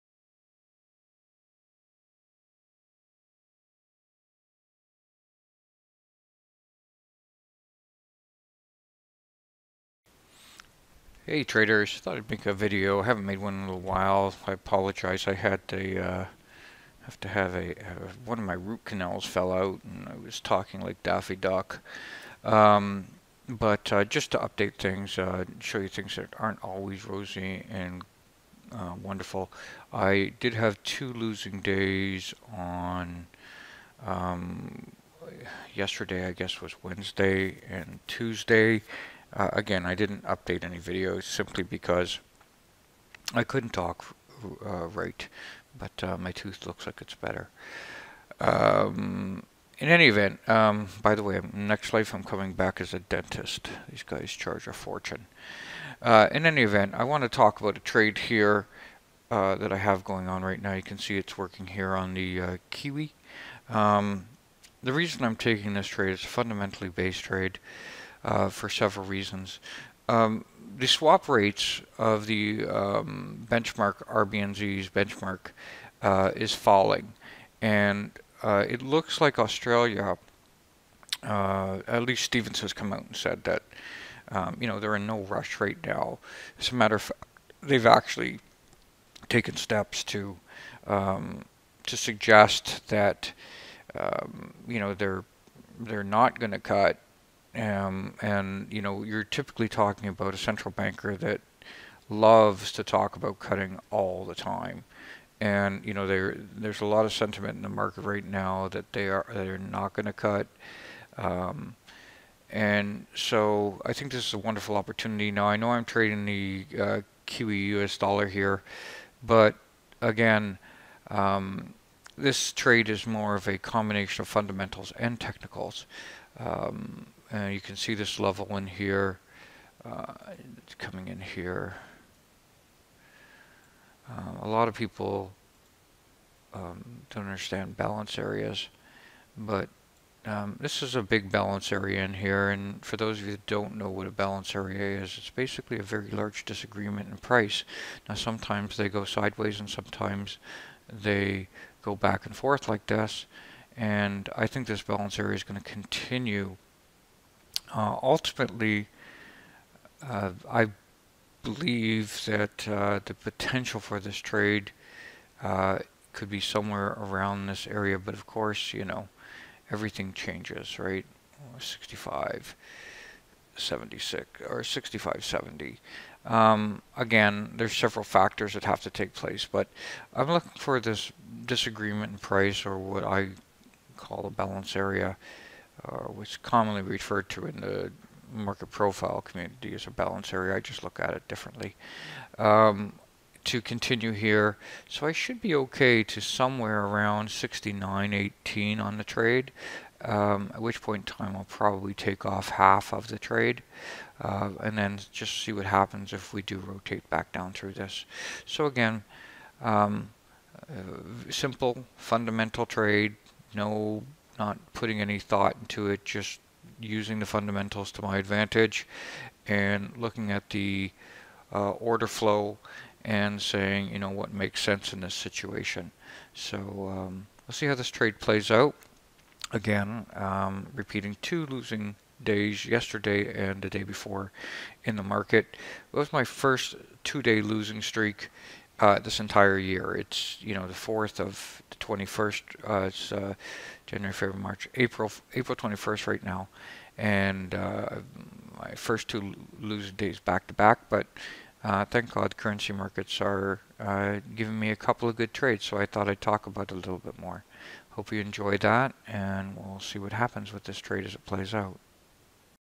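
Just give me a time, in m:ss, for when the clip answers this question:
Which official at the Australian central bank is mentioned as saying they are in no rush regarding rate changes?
1:22.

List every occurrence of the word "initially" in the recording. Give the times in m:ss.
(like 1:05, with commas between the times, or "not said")
not said.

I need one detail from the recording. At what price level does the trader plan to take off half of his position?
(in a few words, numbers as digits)
69.18.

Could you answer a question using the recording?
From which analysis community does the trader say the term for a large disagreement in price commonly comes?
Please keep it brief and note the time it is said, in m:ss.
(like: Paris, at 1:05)
market profile, at 3:08.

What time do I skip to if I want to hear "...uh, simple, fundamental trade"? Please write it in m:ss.
3:30.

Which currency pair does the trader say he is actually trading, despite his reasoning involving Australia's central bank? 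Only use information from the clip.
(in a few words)
Kiwi US dollar.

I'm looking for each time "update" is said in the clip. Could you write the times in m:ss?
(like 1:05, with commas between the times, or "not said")
0:24, 0:40.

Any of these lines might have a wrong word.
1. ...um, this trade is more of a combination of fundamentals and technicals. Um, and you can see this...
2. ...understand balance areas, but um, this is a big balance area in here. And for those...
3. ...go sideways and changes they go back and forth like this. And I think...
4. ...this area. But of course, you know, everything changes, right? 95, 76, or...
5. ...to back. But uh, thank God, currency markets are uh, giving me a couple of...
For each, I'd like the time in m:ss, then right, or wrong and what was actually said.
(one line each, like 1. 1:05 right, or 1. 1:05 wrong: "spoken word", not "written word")
1. 2:01 right
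2. 2:17 right
3. 2:28 wrong: "sometimes", not "changes"
4. 2:47 wrong: "65", not "95"
5. 4:10 right.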